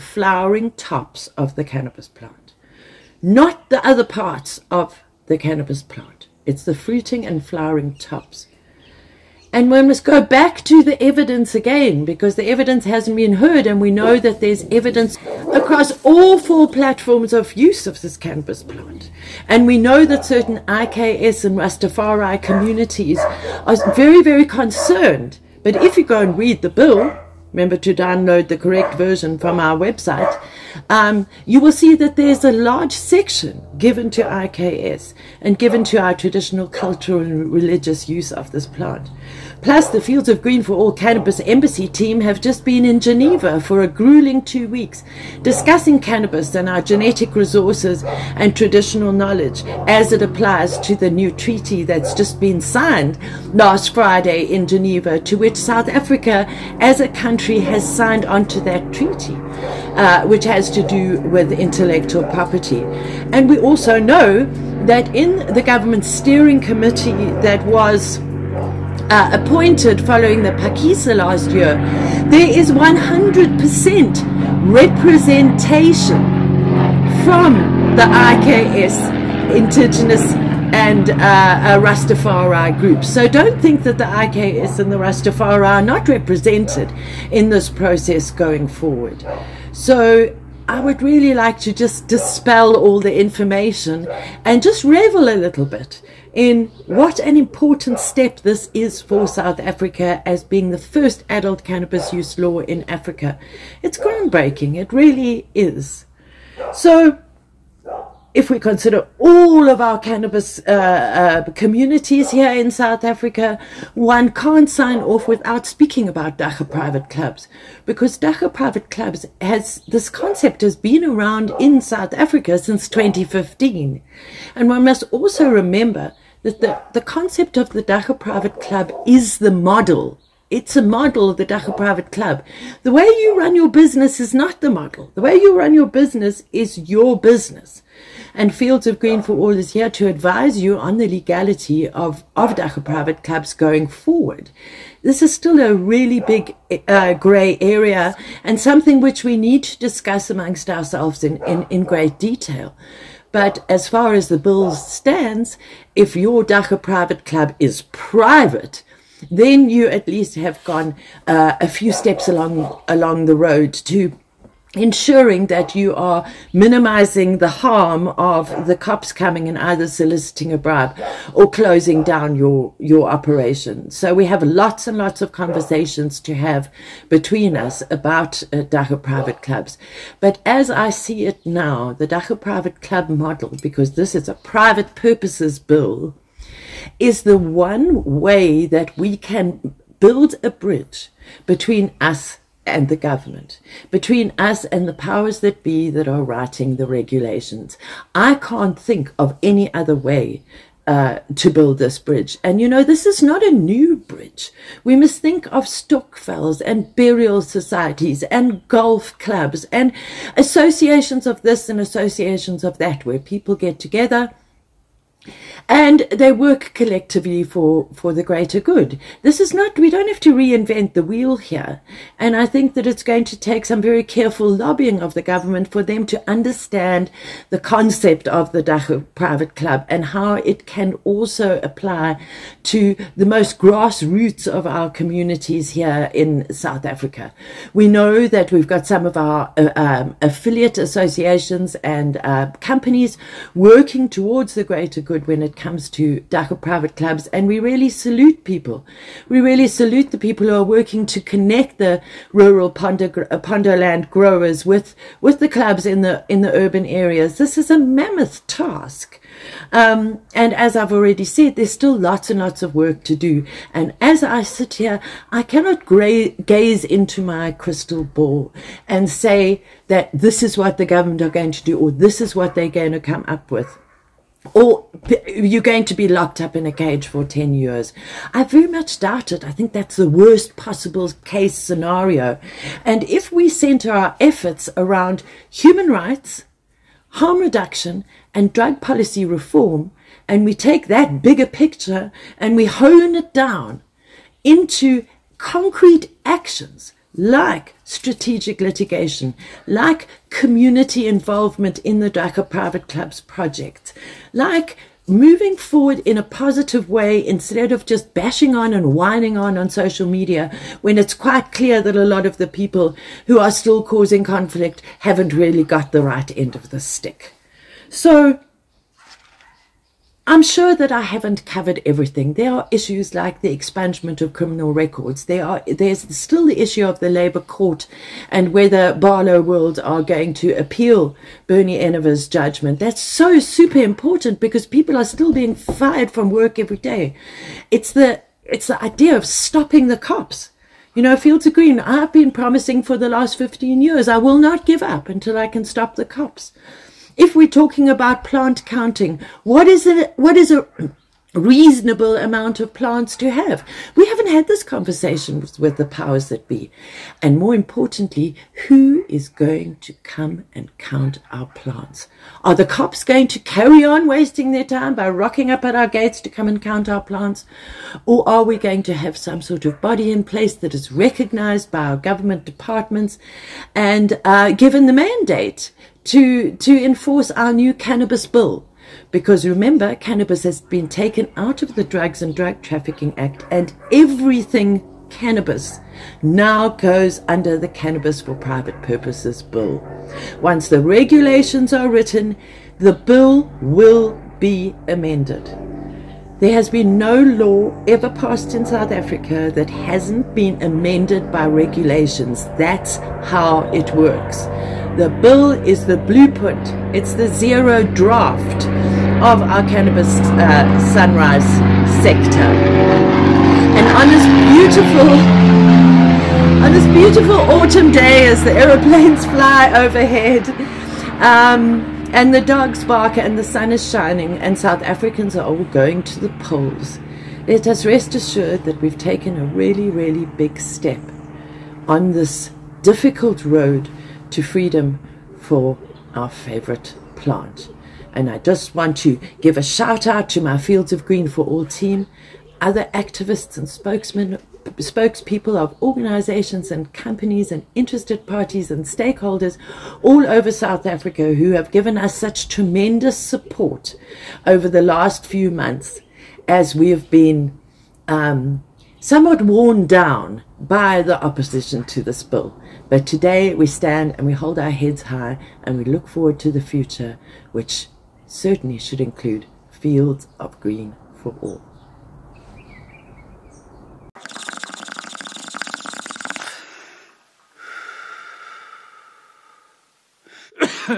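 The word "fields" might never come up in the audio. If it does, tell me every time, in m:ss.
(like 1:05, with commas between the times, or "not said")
0:40, 2:18, 5:41, 7:20, 7:49.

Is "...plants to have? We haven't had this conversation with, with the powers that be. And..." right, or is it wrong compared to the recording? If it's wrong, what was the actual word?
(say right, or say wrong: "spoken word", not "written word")
right.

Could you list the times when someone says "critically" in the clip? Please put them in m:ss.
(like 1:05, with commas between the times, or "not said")
not said.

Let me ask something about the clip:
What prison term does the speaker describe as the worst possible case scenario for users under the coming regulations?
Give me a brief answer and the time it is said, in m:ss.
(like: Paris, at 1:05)
10 years, at 4:37.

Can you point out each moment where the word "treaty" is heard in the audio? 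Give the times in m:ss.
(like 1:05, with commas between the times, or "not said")
0:51, 0:58.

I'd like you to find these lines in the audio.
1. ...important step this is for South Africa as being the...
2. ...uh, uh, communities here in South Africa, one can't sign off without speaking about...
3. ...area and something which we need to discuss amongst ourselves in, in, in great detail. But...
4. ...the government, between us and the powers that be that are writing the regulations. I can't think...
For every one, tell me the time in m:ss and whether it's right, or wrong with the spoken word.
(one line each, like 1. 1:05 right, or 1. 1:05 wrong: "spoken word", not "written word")
1. 1:37 right
2. 1:50 right
3. 2:27 right
4. 3:12 right.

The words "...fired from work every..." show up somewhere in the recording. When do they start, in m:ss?
5:35.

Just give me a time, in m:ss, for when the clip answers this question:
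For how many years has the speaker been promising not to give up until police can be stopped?
5:43.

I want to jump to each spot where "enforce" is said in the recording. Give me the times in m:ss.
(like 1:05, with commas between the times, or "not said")
6:16.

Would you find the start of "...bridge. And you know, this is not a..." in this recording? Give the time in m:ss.
3:21.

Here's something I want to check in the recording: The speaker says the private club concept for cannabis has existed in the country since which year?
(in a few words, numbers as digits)
2015.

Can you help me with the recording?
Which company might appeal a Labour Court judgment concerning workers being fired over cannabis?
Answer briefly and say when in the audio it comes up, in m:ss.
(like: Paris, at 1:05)
Barloworld, at 5:28.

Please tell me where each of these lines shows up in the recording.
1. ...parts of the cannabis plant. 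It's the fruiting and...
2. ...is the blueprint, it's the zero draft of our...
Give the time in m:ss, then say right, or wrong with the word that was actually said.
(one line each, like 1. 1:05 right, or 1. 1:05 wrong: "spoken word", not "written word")
1. 0:04 right
2. 6:45 right.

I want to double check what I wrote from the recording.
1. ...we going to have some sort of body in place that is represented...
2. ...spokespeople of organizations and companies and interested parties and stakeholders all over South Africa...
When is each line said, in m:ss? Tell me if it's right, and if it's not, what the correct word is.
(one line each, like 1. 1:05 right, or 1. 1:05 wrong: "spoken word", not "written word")
1. 6:08 wrong: "recognized", not "represented"
2. 7:24 right.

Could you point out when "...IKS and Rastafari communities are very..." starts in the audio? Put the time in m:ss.
0:20.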